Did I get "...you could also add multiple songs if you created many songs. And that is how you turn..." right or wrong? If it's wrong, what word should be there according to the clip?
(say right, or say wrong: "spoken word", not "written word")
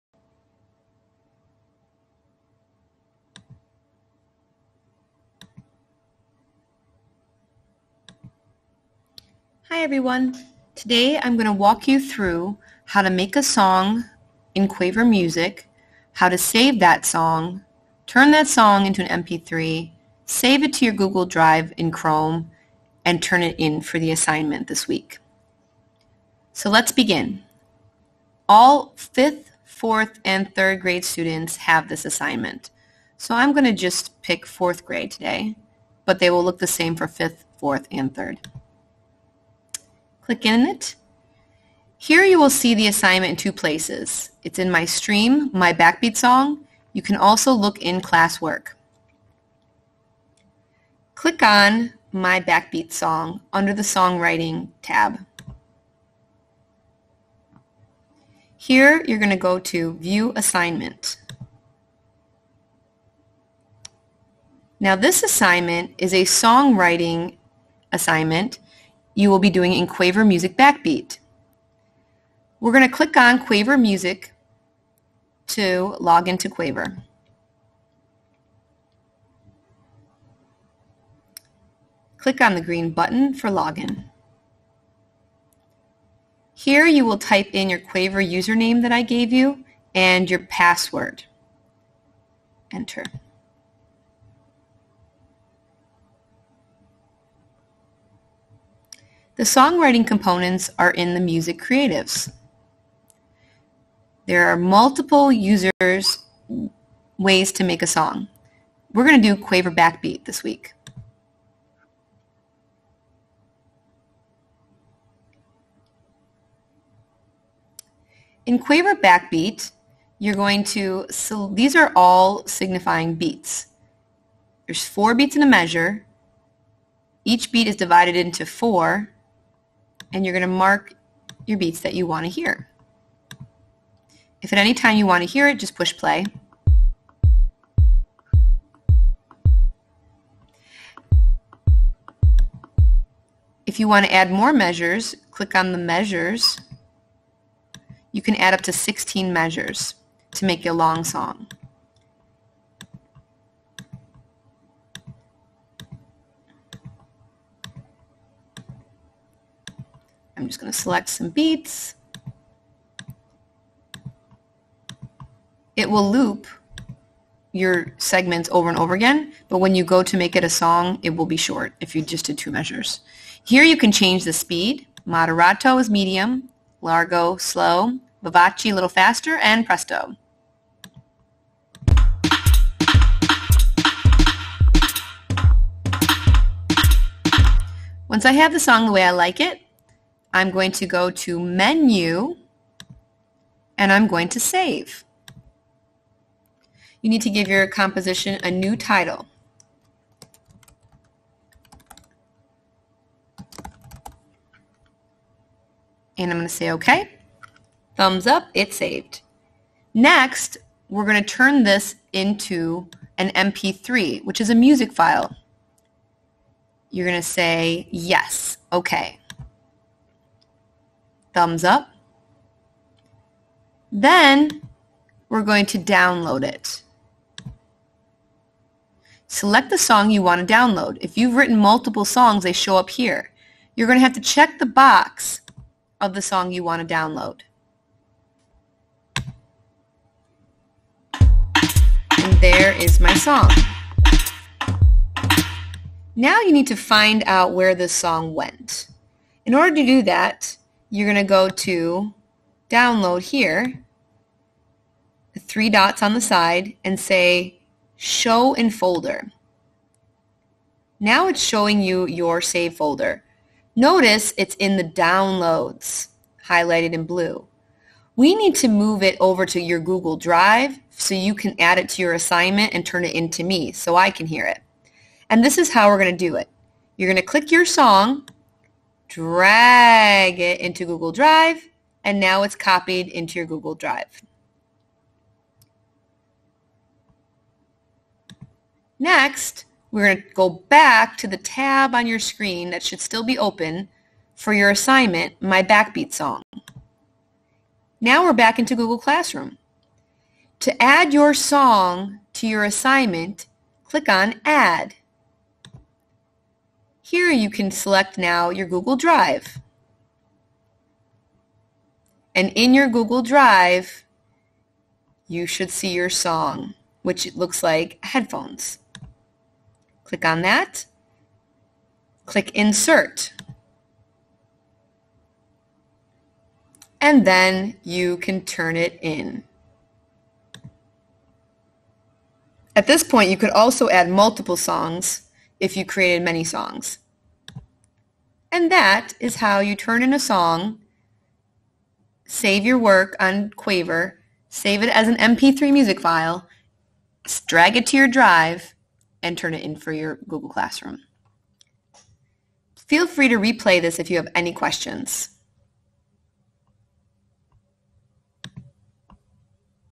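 right.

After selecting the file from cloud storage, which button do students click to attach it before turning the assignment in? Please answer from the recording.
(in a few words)
Insert.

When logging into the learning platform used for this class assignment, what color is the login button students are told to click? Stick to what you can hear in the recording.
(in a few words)
green.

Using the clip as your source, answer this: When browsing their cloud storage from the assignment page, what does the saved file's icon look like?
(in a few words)
Headphones.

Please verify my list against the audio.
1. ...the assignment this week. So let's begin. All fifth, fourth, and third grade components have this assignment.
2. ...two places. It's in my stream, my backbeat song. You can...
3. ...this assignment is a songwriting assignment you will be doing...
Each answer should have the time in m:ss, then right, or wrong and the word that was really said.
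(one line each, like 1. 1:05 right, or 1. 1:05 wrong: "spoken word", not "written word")
1. 0:23 wrong: "students", not "components"
2. 0:43 right
3. 1:04 right.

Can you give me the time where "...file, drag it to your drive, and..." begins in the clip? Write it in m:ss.
5:46.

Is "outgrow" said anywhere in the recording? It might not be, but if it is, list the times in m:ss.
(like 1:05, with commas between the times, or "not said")
not said.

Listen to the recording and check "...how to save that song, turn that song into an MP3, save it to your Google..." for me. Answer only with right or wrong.
right.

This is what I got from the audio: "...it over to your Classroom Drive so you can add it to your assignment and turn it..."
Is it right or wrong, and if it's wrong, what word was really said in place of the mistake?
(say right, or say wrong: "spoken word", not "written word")
wrong: "Google", not "Classroom".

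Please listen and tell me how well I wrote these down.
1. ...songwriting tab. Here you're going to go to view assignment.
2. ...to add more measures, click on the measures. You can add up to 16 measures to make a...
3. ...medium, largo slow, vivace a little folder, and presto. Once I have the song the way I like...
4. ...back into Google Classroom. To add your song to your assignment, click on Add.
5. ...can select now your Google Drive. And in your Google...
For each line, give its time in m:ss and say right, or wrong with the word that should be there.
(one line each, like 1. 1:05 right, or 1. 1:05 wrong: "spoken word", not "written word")
1. 0:53 right
2. 2:24 right
3. 2:55 wrong: "faster", not "folder"
4. 4:58 right
5. 5:07 right.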